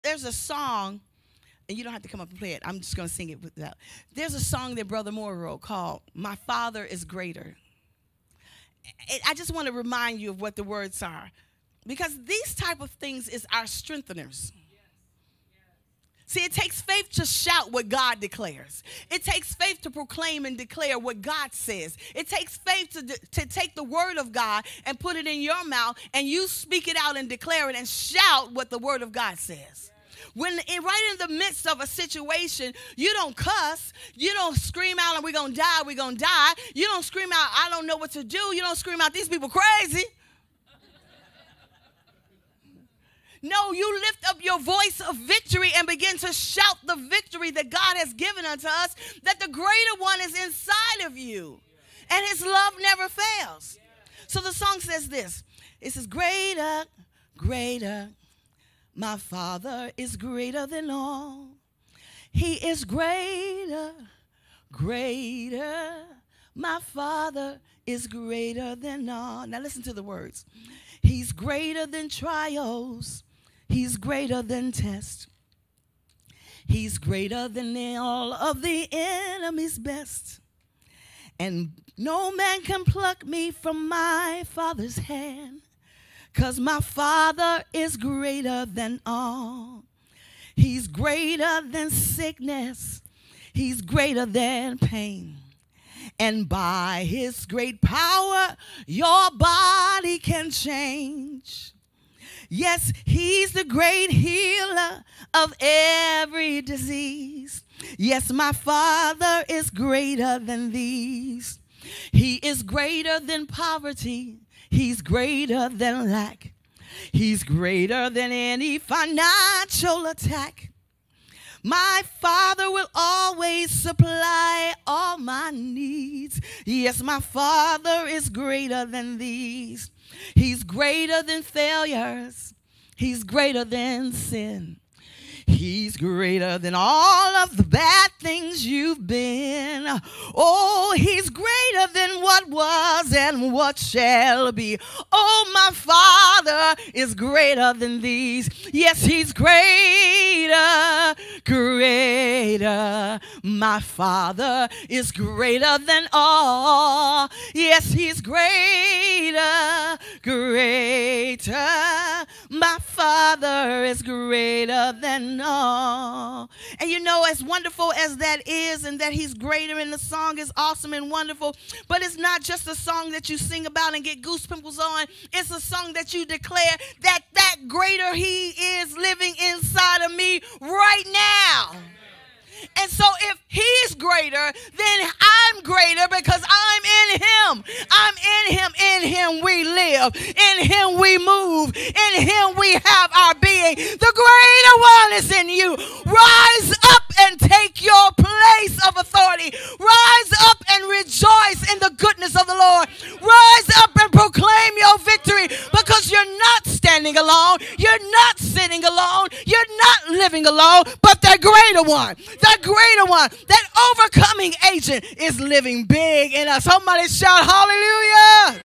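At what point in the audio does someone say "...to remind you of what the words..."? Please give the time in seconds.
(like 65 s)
9 s.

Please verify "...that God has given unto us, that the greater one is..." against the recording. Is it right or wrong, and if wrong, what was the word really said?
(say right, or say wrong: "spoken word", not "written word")
right.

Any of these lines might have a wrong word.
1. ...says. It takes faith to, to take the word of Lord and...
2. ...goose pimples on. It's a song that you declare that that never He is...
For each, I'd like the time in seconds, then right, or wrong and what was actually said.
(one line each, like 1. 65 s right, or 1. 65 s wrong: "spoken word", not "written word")
1. 21 s wrong: "God", not "Lord"
2. 174 s wrong: "greater", not "never".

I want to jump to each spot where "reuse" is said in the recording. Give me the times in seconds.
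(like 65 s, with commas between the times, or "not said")
not said.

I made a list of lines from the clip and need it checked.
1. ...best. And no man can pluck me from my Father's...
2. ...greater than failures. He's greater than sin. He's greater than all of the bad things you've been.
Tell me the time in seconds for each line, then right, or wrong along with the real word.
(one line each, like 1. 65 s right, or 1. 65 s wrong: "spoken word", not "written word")
1. 79 s right
2. 130 s right.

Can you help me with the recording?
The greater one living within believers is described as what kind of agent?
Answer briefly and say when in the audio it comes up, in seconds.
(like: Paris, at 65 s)
overcoming, at 213 s.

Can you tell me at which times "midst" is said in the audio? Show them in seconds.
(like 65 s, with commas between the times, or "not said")
31 s.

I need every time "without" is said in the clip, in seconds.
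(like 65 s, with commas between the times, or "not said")
3 s.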